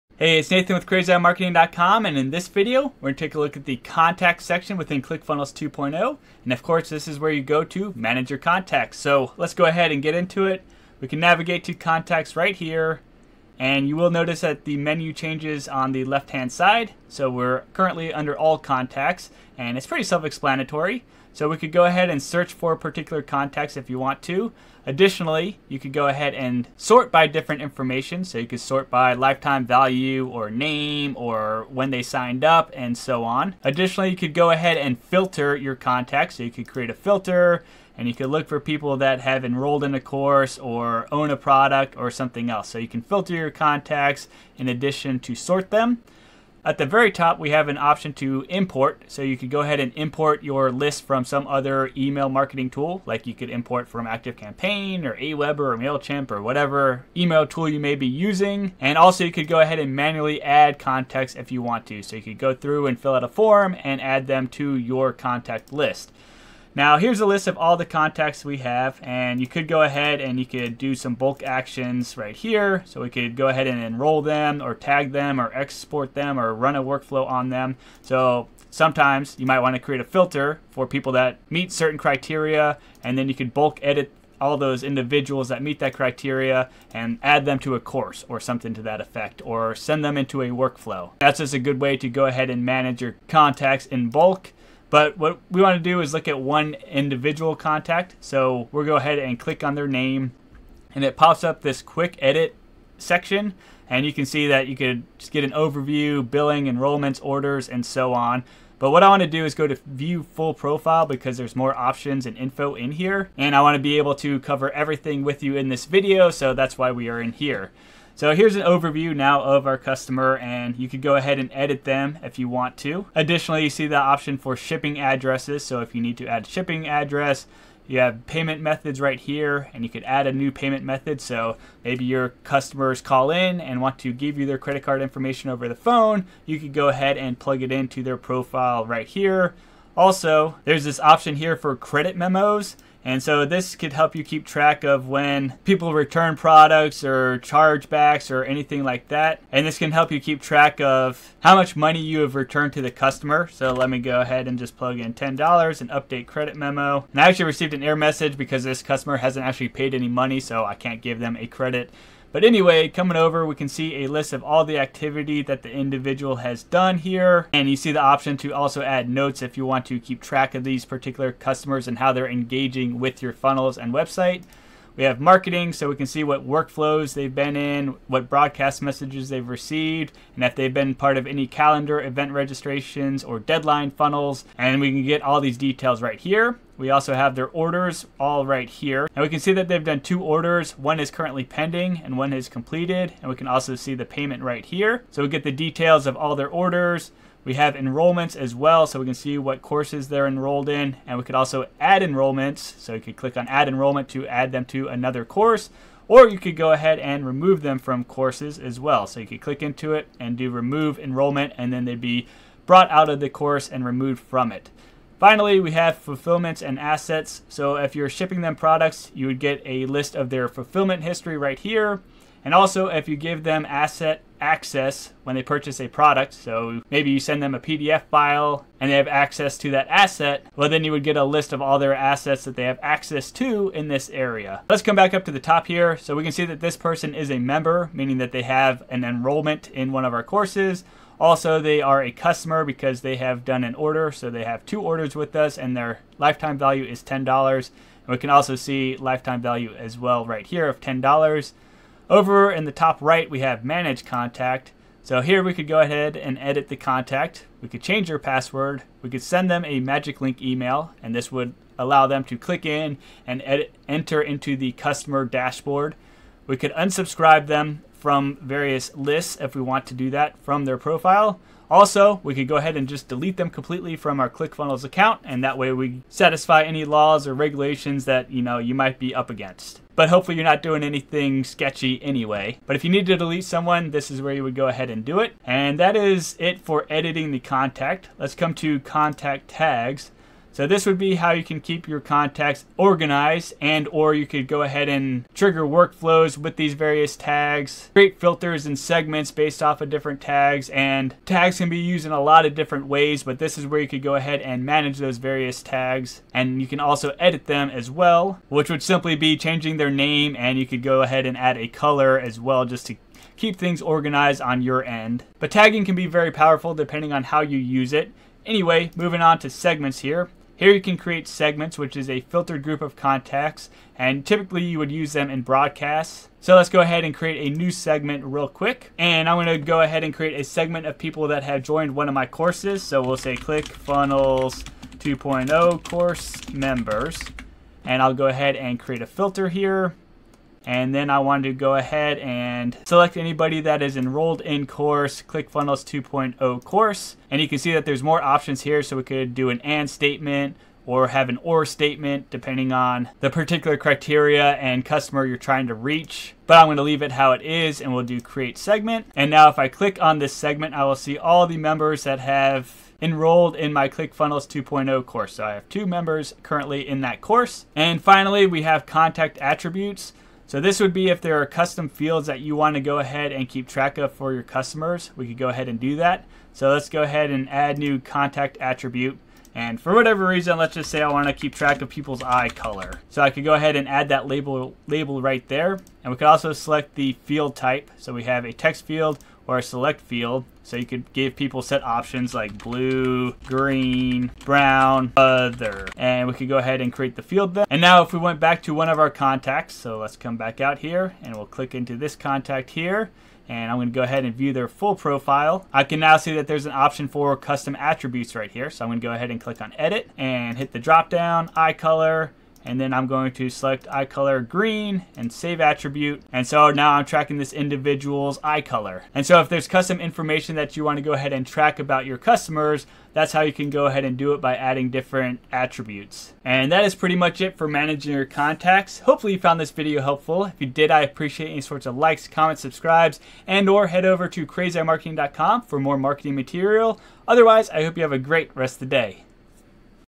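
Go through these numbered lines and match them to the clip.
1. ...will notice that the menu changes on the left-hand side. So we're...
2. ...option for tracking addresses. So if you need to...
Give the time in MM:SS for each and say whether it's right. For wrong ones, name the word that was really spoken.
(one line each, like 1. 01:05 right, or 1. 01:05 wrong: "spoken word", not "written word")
1. 00:13 right
2. 02:03 wrong: "shipping", not "tracking".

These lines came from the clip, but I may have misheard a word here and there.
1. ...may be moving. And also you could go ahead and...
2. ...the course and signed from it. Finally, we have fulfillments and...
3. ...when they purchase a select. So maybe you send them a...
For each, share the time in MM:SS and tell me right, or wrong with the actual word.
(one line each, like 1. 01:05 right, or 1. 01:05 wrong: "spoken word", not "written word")
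1. 00:57 wrong: "using", not "moving"
2. 03:33 wrong: "removed", not "signed"
3. 03:45 wrong: "product", not "select".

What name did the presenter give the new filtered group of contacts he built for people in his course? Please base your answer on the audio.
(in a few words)
ClickFunnels 2.0 course members.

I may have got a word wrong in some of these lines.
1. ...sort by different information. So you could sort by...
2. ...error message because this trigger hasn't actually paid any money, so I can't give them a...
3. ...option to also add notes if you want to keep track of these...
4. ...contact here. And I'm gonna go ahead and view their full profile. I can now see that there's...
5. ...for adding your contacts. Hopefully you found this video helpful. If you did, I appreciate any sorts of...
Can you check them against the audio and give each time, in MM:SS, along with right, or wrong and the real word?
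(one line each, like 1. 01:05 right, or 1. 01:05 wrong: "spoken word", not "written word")
1. 00:26 right
2. 02:37 wrong: "customer", not "trigger"
3. 02:48 right
4. 06:42 right
5. 07:07 wrong: "managing", not "adding".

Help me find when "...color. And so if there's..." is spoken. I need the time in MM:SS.
06:58.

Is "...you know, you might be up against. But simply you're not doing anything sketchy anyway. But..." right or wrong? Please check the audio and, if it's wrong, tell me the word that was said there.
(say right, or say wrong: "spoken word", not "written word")
wrong: "hopefully", not "simply".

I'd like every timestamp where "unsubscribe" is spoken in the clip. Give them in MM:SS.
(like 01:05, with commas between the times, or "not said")
04:26.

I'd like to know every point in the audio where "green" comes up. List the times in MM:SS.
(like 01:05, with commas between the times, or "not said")
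06:33, 06:54.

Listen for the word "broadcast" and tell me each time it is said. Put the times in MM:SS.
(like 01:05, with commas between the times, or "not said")
02:58, 05:25.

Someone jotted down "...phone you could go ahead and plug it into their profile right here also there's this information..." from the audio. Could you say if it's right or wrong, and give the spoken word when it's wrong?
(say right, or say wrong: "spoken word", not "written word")
wrong: "option", not "information".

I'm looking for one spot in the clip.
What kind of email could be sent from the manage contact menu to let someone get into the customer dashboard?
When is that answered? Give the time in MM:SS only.
04:19.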